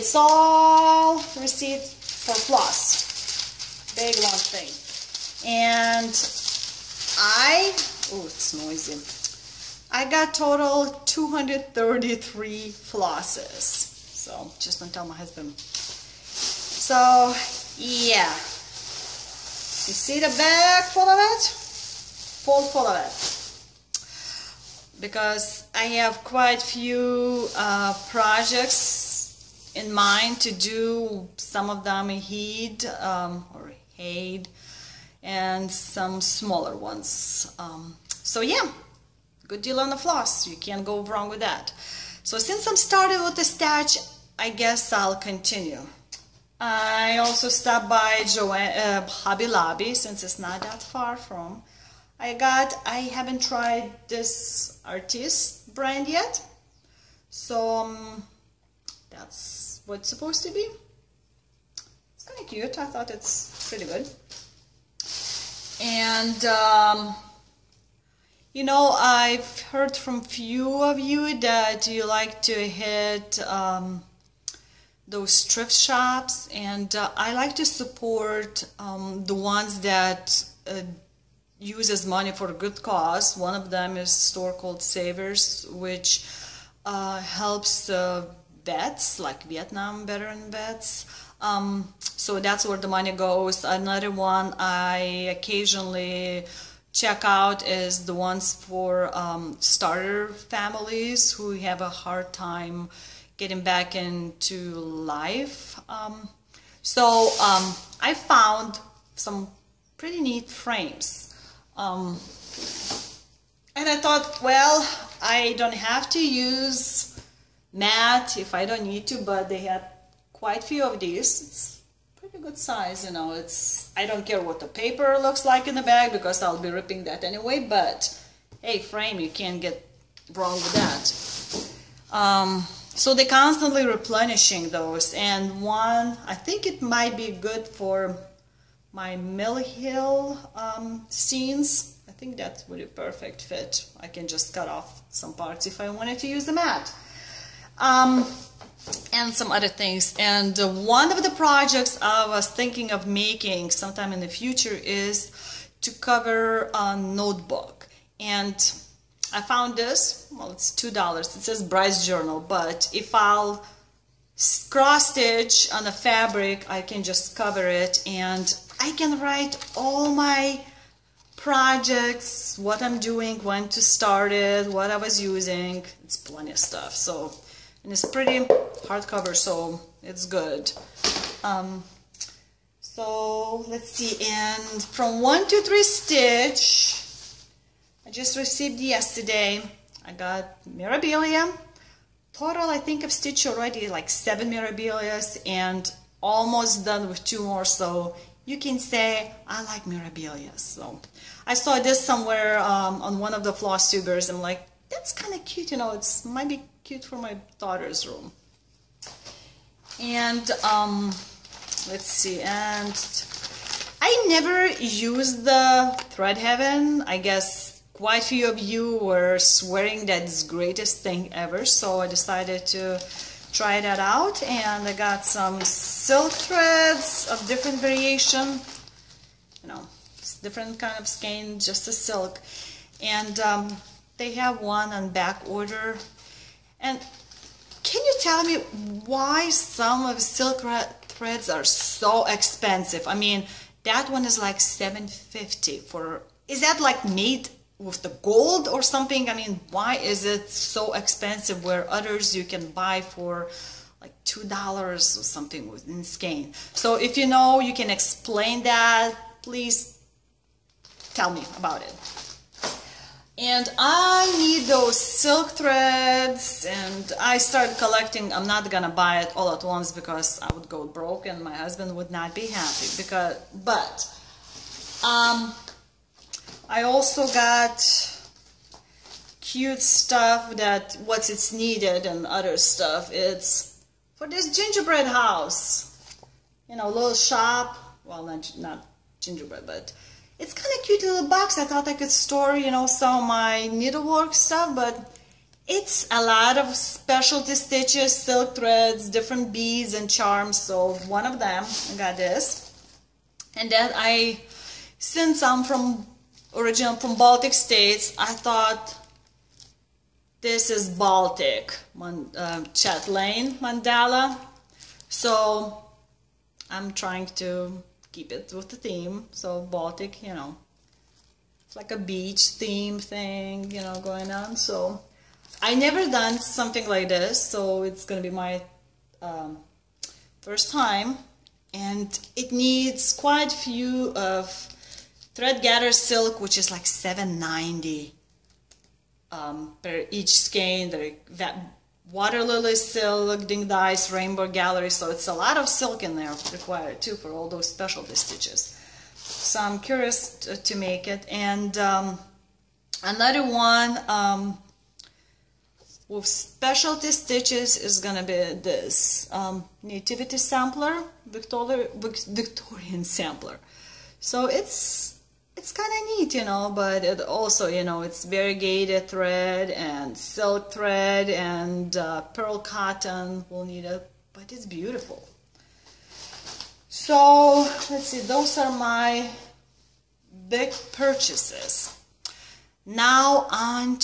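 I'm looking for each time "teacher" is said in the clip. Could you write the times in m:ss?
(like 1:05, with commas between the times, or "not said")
not said.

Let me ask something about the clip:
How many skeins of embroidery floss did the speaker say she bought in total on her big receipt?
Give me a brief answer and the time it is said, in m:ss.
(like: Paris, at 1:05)
233, at 0:11.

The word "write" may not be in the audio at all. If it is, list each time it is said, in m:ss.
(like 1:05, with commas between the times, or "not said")
2:49.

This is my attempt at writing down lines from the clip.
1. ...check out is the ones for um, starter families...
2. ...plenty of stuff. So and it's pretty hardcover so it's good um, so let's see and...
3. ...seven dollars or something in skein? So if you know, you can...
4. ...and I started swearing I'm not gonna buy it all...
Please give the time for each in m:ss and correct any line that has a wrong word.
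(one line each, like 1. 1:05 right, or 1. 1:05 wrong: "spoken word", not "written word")
1. 1:36 right
2. 2:56 right
3. 4:14 wrong: "two", not "seven"
4. 4:26 wrong: "collecting", not "swearing".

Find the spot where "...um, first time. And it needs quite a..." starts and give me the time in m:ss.
5:29.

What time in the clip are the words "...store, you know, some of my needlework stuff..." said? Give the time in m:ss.
4:52.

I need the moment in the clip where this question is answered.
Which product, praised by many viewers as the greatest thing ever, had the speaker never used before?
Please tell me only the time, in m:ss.
3:36.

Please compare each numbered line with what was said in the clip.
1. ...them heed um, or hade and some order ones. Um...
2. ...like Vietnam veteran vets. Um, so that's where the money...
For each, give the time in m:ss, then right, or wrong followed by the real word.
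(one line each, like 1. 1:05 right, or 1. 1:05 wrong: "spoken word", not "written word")
1. 0:31 wrong: "smaller", not "order"
2. 1:29 right.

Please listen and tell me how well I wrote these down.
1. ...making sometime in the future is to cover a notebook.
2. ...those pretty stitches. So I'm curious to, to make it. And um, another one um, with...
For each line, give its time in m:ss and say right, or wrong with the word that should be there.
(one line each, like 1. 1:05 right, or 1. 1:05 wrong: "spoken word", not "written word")
1. 2:33 right
2. 5:47 wrong: "specialty", not "pretty".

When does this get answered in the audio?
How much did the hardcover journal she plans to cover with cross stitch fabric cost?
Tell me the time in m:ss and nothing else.
2:40.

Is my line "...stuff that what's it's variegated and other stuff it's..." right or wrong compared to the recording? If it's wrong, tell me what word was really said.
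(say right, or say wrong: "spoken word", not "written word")
wrong: "needed", not "variegated".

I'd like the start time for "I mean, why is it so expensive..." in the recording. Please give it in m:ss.
4:09.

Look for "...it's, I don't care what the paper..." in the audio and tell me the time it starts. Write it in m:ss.
2:03.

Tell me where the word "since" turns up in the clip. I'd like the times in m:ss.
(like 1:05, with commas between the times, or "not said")
0:42, 0:49, 5:04.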